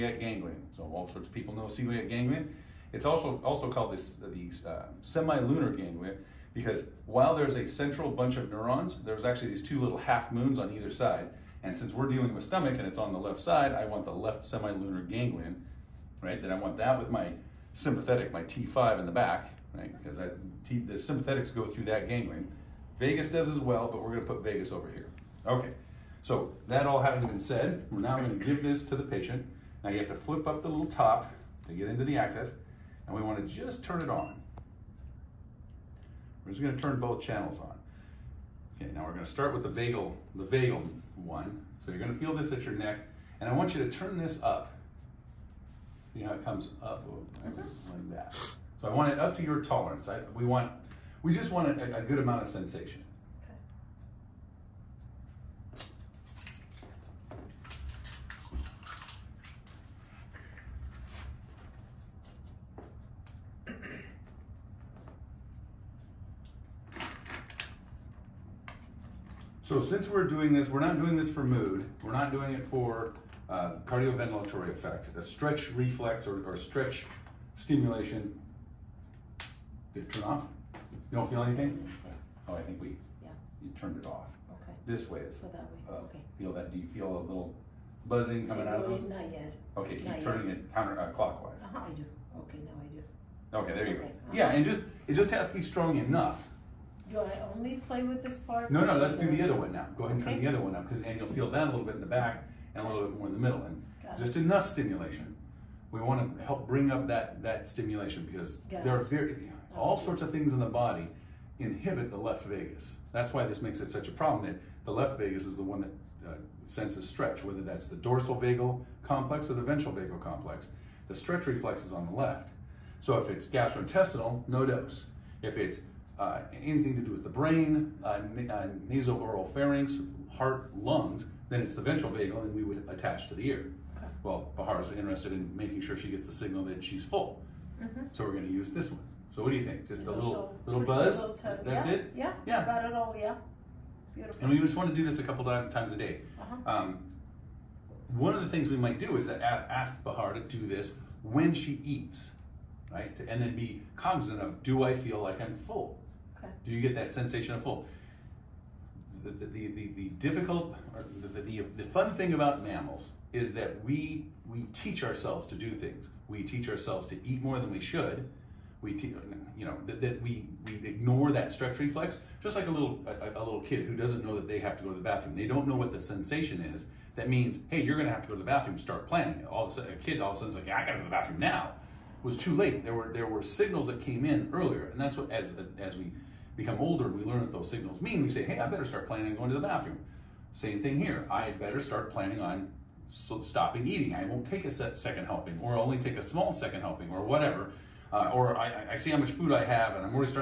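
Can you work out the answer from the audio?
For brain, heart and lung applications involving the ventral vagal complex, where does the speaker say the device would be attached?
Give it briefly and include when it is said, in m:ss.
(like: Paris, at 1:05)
the ear, at 2:13.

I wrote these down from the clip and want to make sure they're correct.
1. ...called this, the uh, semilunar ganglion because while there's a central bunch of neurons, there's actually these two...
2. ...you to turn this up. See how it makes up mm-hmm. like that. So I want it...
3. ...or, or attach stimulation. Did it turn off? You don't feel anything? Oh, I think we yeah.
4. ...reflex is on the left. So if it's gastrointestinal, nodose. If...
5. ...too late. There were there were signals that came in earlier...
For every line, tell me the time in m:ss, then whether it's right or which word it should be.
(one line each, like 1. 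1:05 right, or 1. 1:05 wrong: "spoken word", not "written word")
1. 0:03 right
2. 0:43 wrong: "comes", not "makes"
3. 1:16 wrong: "stretch", not "attach"
4. 2:01 right
5. 3:02 right.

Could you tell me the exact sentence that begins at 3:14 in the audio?
I won't take a second helping, or only take a small second helping, or whatever.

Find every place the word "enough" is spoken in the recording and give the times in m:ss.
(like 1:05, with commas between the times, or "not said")
1:35, 1:44.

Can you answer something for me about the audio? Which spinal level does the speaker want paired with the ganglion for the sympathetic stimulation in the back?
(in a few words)
T5.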